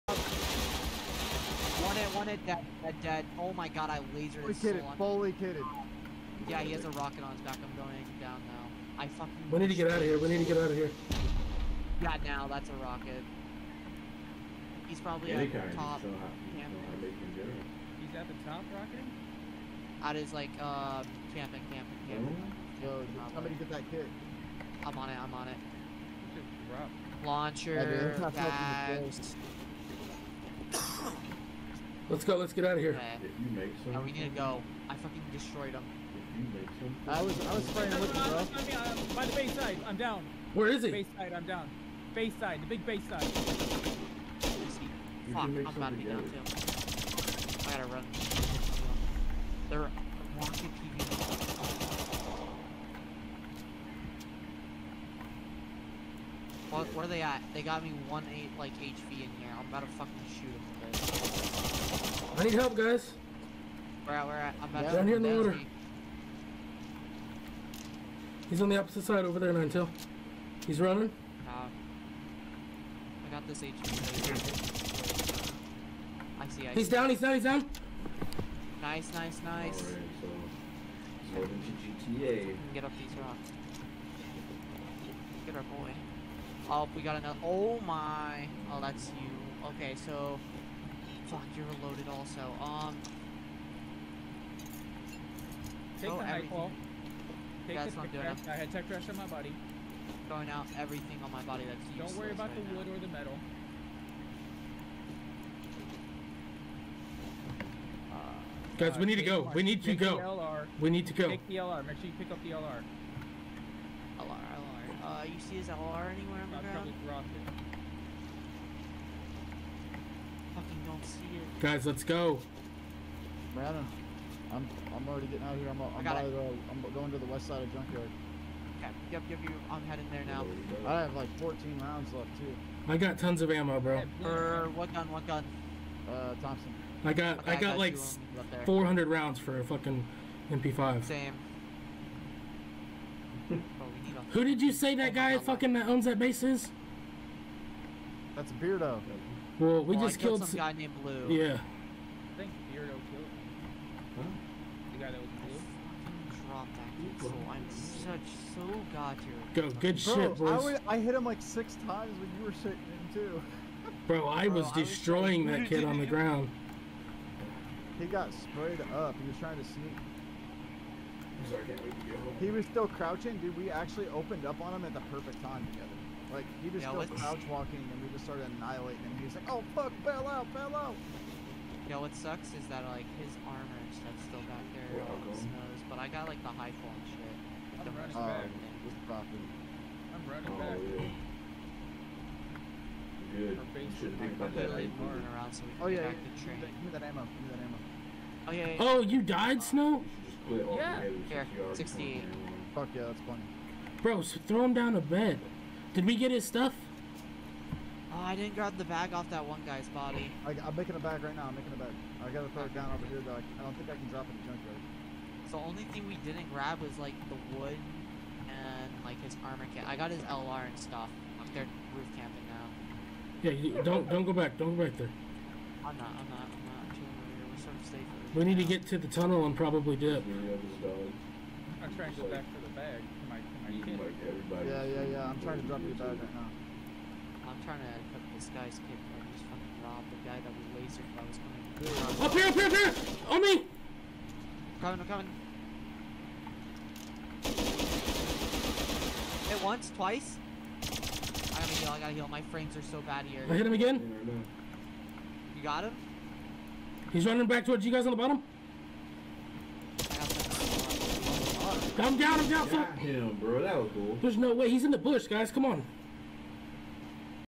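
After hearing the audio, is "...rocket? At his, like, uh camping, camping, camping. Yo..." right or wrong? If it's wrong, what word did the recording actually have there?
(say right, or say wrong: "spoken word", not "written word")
right.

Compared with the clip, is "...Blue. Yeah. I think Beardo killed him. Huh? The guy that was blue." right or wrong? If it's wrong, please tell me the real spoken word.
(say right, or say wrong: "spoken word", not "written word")
right.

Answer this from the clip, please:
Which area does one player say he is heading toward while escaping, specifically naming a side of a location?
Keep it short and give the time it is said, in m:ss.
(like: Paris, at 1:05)
west side of junkyard, at 2:07.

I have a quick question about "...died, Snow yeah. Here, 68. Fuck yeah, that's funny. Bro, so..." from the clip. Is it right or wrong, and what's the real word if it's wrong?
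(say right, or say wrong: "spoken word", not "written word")
right.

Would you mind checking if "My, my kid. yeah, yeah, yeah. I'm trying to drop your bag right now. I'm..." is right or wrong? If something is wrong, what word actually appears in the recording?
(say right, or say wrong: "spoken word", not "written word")
right.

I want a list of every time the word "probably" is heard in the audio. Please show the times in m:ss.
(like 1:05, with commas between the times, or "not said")
0:14, 1:56, 3:49.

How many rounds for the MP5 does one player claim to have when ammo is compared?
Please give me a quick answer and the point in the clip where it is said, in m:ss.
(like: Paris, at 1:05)
400, at 2:18.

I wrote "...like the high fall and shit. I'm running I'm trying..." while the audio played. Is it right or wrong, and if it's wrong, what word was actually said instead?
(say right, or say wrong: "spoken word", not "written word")
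wrong: "running", not "trying".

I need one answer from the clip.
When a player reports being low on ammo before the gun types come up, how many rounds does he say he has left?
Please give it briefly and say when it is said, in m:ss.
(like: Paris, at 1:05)
14, at 2:11.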